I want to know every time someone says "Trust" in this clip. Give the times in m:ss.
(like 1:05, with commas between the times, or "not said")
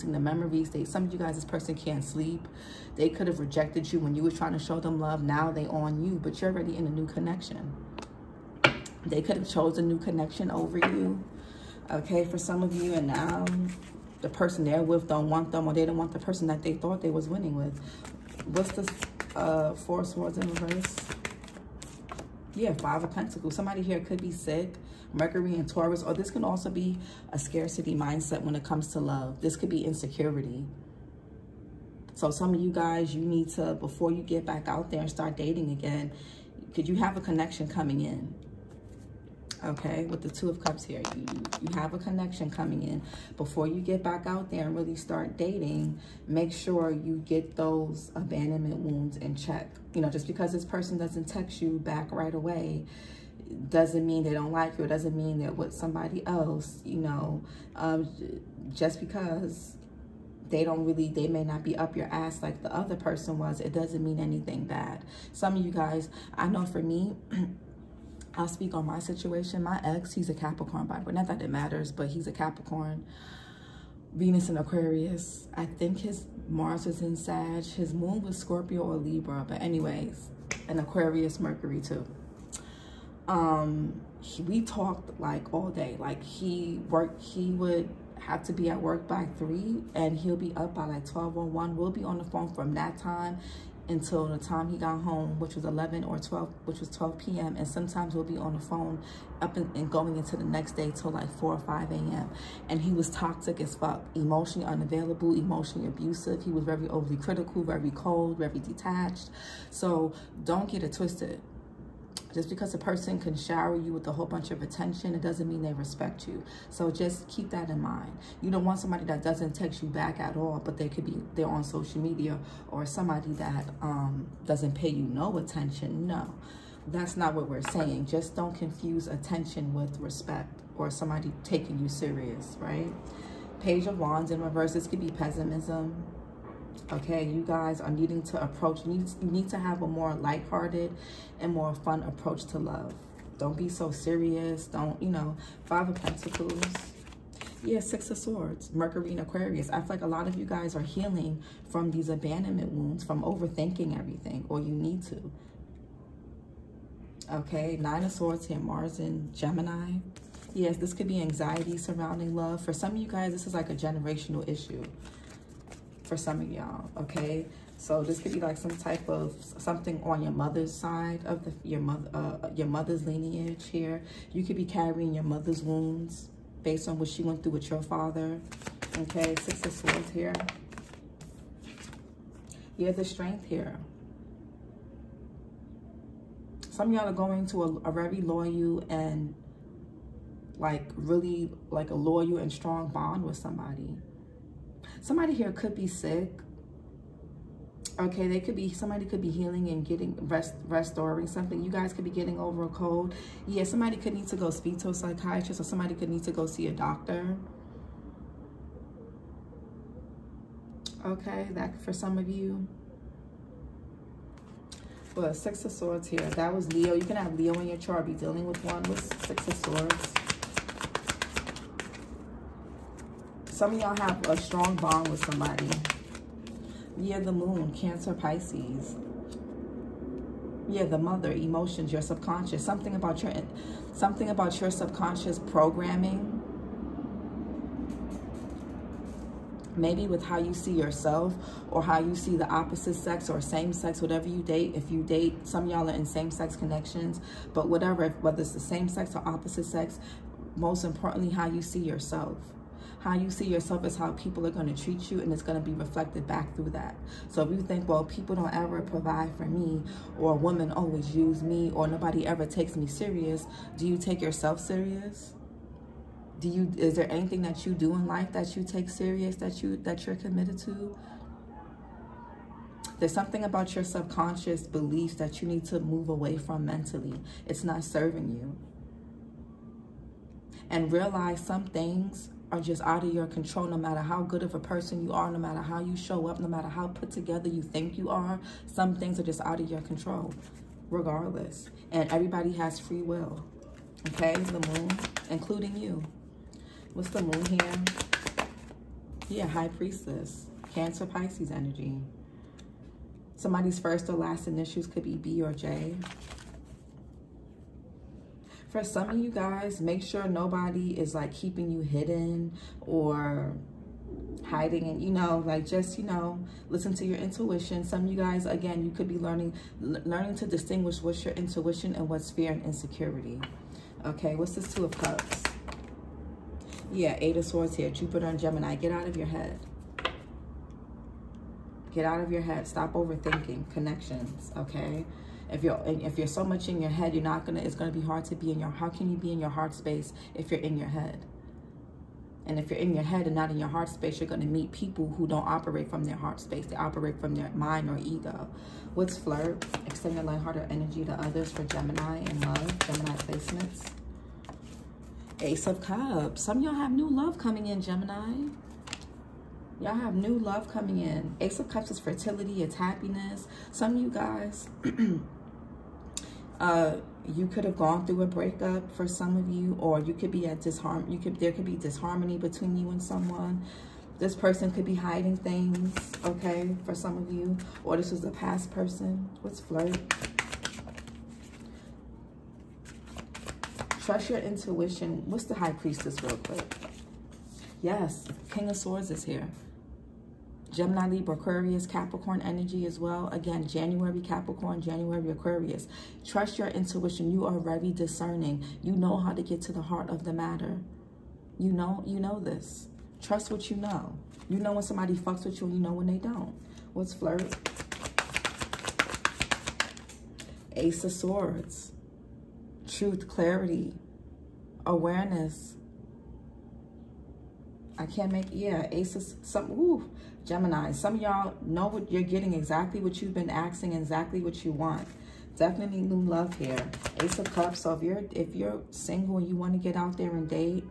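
6:24, 6:36, 6:43.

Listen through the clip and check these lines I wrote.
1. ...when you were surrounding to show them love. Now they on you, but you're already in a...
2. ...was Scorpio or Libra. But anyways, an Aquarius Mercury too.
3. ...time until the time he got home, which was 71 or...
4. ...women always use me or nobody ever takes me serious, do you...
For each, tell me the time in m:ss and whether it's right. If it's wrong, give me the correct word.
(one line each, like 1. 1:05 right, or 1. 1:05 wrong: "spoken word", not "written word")
1. 0:03 wrong: "trying", not "surrounding"
2. 1:18 right
3. 1:32 wrong: "11", not "71"
4. 4:20 right.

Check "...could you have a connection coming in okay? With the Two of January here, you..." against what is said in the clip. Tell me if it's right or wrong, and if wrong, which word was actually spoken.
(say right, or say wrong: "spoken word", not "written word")
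wrong: "Cups", not "January".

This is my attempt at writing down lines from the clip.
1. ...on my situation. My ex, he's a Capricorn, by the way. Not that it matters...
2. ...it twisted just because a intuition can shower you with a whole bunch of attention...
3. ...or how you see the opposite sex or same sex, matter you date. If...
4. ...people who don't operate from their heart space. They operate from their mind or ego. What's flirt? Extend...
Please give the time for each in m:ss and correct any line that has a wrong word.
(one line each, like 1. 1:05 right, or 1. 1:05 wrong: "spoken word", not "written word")
1. 1:08 right
2. 1:50 wrong: "person", not "intuition"
3. 4:01 wrong: "whatever", not "matter"
4. 5:44 right.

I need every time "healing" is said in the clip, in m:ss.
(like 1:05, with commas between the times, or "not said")
2:30, 3:19.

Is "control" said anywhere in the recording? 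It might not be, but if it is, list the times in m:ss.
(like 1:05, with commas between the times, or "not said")
4:43, 4:49.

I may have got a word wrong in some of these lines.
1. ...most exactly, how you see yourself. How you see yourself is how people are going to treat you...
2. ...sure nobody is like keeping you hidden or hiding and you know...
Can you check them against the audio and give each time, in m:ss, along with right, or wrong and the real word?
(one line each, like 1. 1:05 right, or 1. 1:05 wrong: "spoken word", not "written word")
1. 4:10 wrong: "importantly", not "exactly"
2. 5:10 right.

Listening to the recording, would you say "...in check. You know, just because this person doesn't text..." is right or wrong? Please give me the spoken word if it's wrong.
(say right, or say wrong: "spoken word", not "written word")
right.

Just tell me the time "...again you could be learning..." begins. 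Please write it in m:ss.
5:18.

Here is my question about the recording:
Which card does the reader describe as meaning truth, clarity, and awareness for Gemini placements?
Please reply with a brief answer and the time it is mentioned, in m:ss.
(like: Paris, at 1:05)
Ace of Swords, at 6:50.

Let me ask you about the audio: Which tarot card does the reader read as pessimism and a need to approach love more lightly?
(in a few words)
Page of Wands in reverse.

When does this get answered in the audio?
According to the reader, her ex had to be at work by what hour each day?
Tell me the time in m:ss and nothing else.
1:28.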